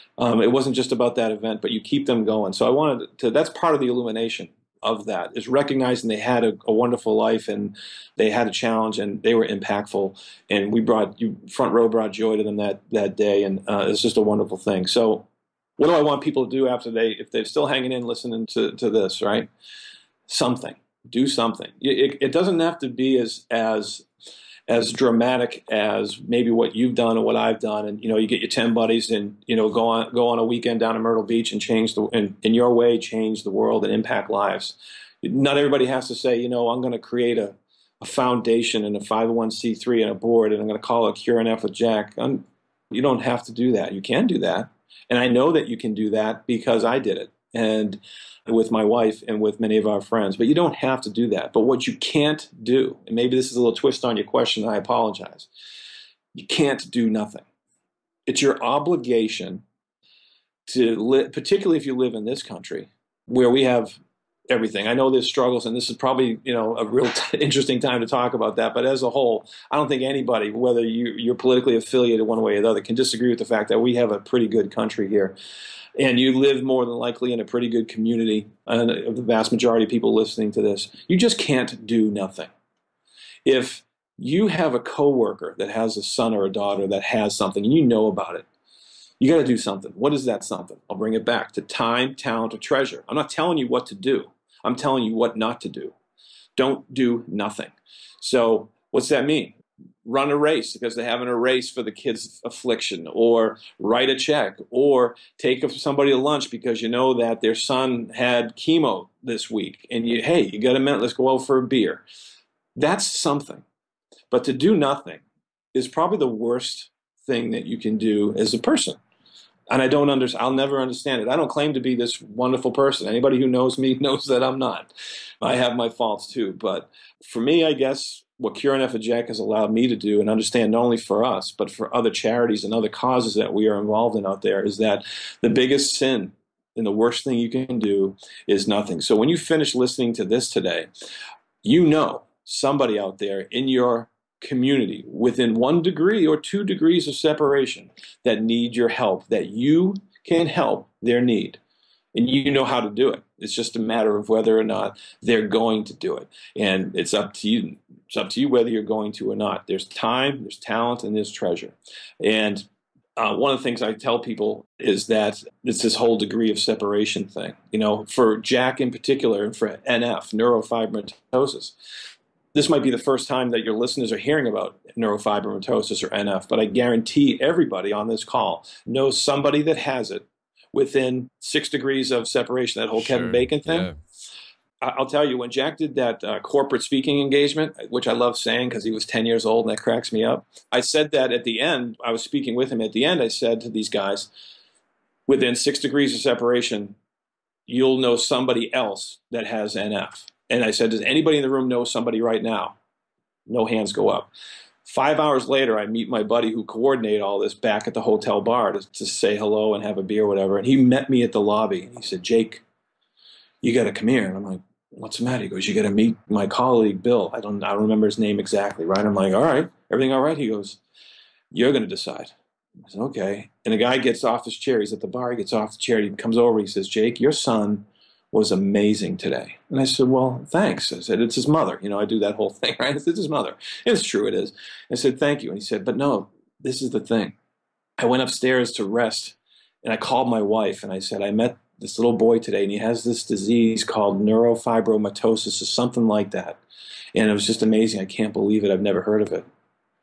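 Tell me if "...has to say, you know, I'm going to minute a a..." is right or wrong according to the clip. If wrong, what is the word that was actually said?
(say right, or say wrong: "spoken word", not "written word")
wrong: "create", not "minute".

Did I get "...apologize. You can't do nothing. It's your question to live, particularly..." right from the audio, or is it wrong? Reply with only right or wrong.
wrong.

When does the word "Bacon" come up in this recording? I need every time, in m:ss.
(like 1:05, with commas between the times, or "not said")
3:03.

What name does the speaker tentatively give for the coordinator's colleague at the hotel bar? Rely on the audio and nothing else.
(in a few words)
Bill.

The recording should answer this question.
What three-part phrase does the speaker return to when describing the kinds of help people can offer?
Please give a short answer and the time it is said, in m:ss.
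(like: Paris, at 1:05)
time, talent, or treasure, at 1:31.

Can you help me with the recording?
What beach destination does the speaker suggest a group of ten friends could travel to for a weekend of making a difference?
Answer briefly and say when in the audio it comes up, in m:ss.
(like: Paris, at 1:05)
Myrtle Beach, at 0:31.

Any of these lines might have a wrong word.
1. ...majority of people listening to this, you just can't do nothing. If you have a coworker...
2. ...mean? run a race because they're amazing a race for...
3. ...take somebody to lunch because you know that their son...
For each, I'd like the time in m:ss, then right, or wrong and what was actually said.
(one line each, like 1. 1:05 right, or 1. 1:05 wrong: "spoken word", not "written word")
1. 1:19 right
2. 1:39 wrong: "having", not "amazing"
3. 1:45 right.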